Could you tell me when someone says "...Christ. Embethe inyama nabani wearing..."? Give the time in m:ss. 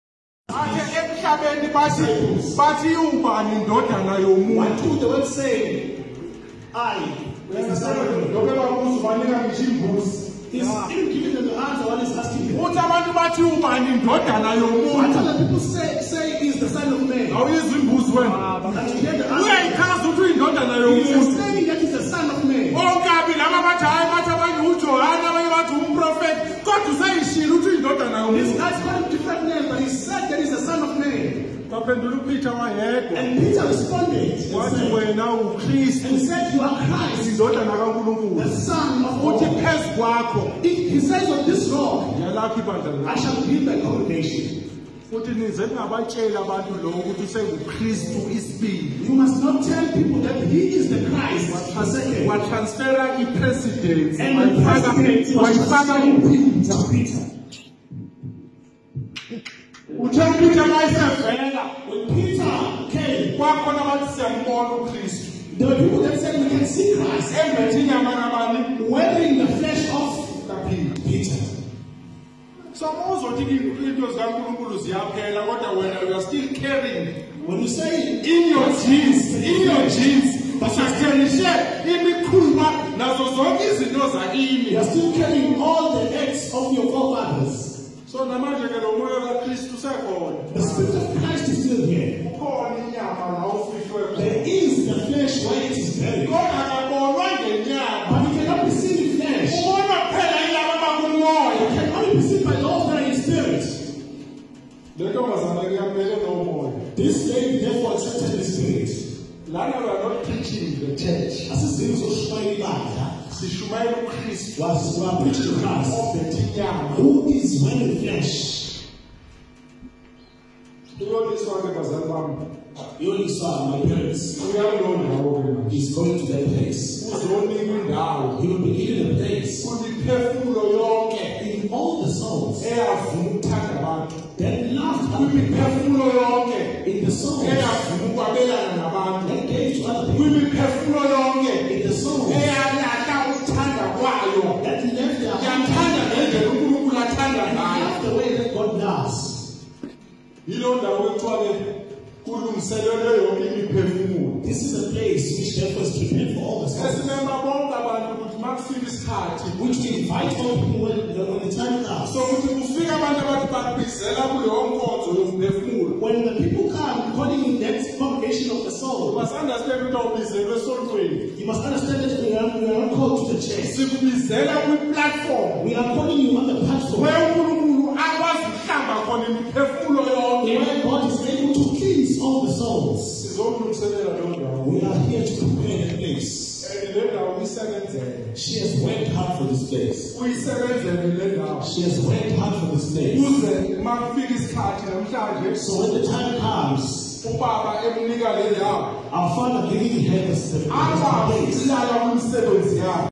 1:06.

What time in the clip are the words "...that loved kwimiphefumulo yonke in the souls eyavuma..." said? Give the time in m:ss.
2:14.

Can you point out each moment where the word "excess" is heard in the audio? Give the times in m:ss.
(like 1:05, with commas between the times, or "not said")
not said.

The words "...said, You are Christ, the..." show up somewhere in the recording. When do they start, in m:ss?
0:36.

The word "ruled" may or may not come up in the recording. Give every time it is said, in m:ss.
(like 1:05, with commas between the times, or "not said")
not said.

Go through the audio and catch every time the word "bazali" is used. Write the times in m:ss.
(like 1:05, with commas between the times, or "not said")
2:01.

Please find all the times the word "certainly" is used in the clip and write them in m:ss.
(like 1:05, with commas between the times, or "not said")
not said.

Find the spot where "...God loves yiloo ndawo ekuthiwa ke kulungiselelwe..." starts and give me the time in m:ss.
2:28.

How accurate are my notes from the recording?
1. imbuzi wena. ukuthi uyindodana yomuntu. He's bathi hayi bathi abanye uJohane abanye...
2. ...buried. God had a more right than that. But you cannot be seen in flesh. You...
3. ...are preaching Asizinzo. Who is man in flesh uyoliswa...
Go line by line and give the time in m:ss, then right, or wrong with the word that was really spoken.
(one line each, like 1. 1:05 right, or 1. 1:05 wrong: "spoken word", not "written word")
1. 0:17 right
2. 1:35 right
3. 1:55 wrong: "Christ", not "Asizinzo".